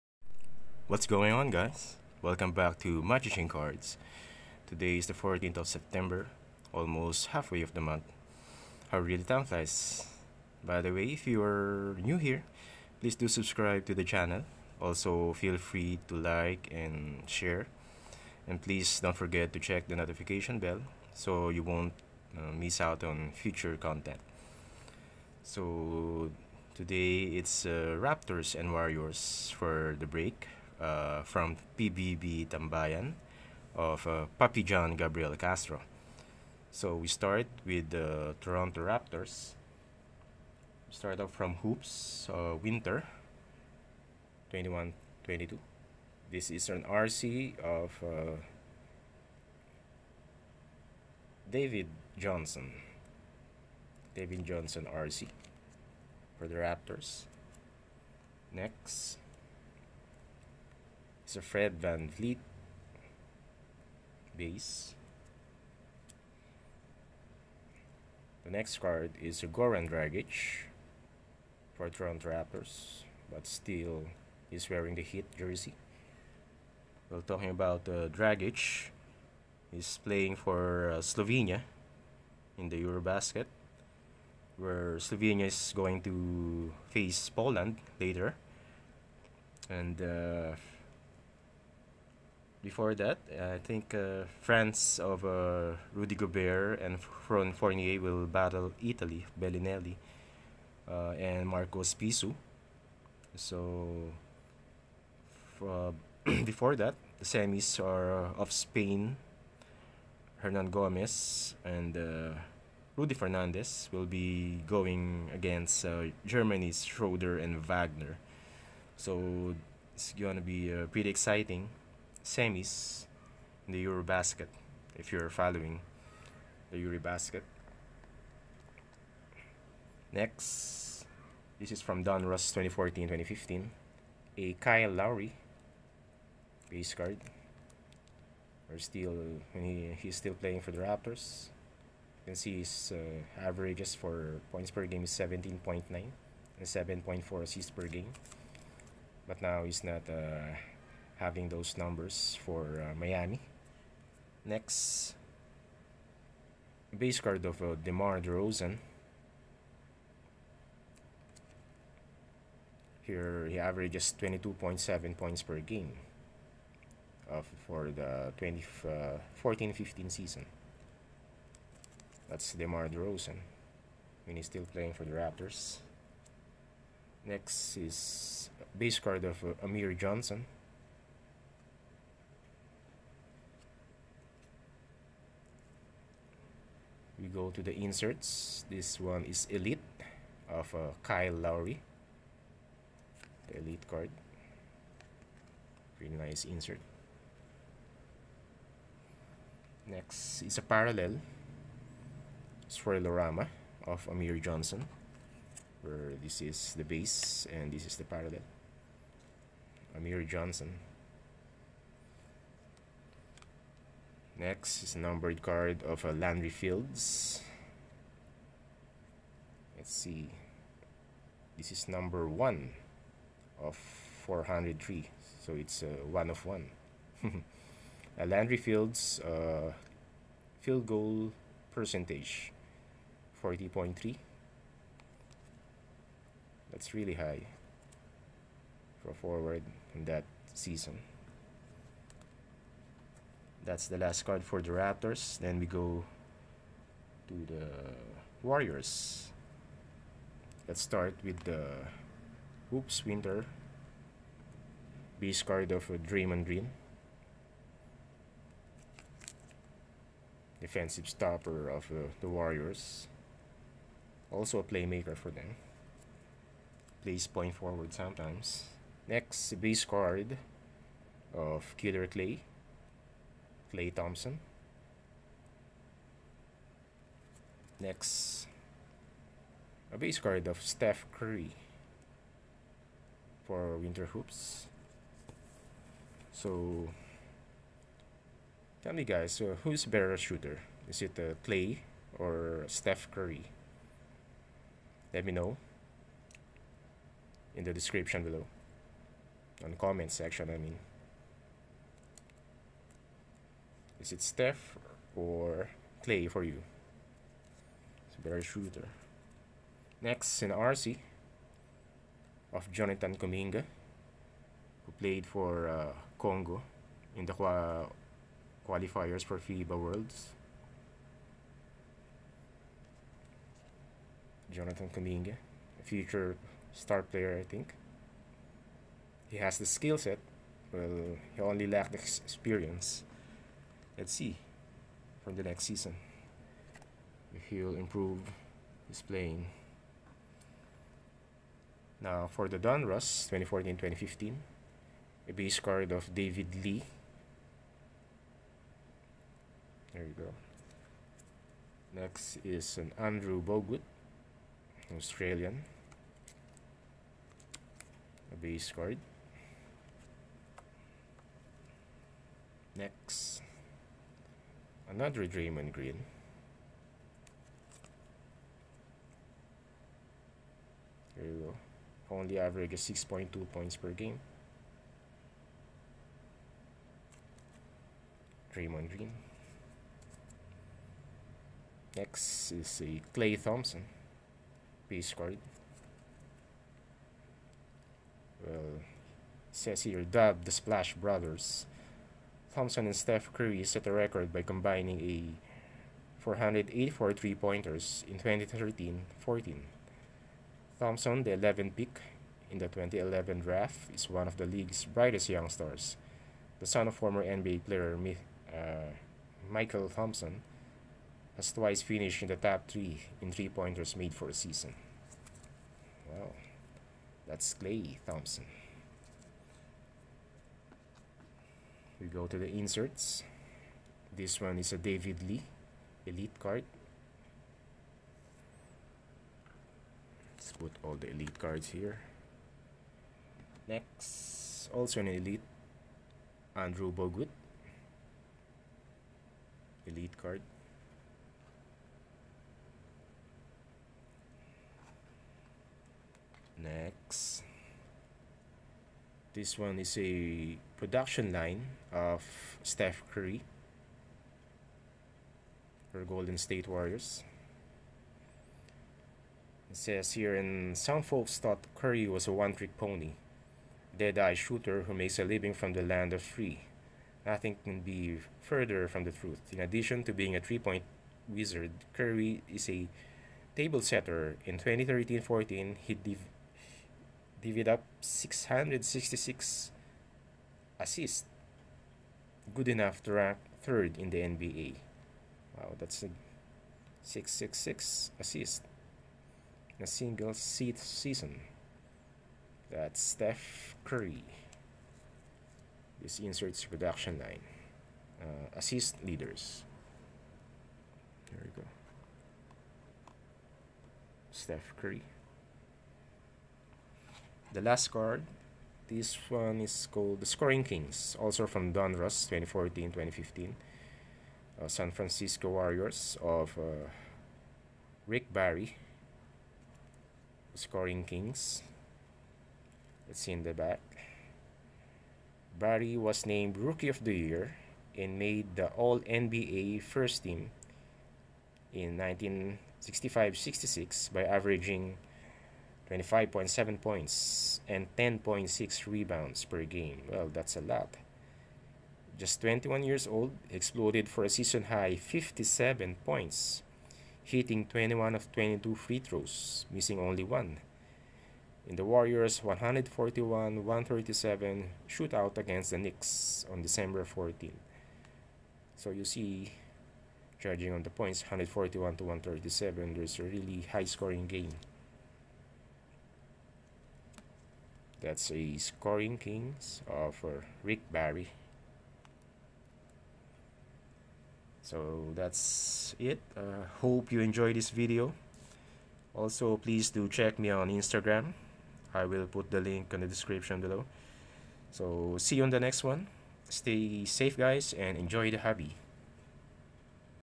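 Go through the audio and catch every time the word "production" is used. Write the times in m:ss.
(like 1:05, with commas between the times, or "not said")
7:30, 8:16.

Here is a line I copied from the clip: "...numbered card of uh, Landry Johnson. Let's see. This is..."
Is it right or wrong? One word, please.
wrong.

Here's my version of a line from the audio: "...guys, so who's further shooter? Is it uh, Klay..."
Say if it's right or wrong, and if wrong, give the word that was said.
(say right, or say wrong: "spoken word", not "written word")
wrong: "better", not "further".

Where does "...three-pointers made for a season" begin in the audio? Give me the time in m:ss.
6:53.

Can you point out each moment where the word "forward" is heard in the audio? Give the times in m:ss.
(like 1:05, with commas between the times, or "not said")
3:59, 4:27.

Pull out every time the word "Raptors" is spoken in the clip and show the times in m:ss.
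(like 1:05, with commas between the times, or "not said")
0:27, 0:38, 0:56, 1:12, 2:20, 2:55, 4:04.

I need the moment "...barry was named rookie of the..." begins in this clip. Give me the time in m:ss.
8:45.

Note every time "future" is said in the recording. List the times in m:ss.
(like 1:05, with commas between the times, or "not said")
0:23, 5:25.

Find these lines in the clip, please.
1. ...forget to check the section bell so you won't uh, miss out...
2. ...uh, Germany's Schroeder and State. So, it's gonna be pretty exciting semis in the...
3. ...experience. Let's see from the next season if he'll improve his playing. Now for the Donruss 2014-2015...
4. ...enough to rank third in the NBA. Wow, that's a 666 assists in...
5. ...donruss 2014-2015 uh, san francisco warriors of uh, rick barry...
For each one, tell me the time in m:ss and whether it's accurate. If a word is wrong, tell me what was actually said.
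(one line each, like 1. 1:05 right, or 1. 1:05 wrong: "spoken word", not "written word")
1. 0:19 wrong: "notification", not "section"
2. 1:55 wrong: "Wagner", not "State"
3. 5:31 right
4. 8:02 right
5. 8:31 right.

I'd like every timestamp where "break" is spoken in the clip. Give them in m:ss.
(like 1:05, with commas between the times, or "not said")
0:30.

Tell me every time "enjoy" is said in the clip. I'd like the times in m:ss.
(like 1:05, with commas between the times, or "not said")
9:37, 9:47.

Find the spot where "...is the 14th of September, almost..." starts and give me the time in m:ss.
0:04.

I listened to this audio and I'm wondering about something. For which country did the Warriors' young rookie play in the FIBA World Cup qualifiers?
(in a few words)
Congo.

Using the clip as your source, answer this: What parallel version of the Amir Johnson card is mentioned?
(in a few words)
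Swirlorama.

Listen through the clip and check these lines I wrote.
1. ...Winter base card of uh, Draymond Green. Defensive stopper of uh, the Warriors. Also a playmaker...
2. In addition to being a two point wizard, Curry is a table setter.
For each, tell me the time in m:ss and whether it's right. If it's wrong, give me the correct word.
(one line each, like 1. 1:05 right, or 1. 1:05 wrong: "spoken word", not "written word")
1. 4:13 right
2. 7:49 wrong: "three", not "two".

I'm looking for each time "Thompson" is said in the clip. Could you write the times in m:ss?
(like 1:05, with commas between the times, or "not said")
4:33, 6:23, 6:32, 6:40, 6:49, 6:58.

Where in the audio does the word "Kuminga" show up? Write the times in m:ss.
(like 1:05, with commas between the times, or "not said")
5:13, 5:24.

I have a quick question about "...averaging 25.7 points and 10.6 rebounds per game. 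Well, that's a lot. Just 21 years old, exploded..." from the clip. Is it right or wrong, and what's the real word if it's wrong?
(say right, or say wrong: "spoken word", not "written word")
right.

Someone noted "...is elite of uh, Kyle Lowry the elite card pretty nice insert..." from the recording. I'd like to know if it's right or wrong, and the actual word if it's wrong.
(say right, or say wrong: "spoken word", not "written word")
right.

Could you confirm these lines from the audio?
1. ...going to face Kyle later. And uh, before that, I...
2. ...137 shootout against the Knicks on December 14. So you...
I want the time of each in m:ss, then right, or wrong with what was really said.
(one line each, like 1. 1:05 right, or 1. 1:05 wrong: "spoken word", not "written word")
1. 1:25 wrong: "Poland", not "Kyle"
2. 9:13 right.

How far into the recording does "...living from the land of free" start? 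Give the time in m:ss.
7:45.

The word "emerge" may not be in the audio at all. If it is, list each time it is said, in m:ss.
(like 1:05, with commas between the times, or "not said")
not said.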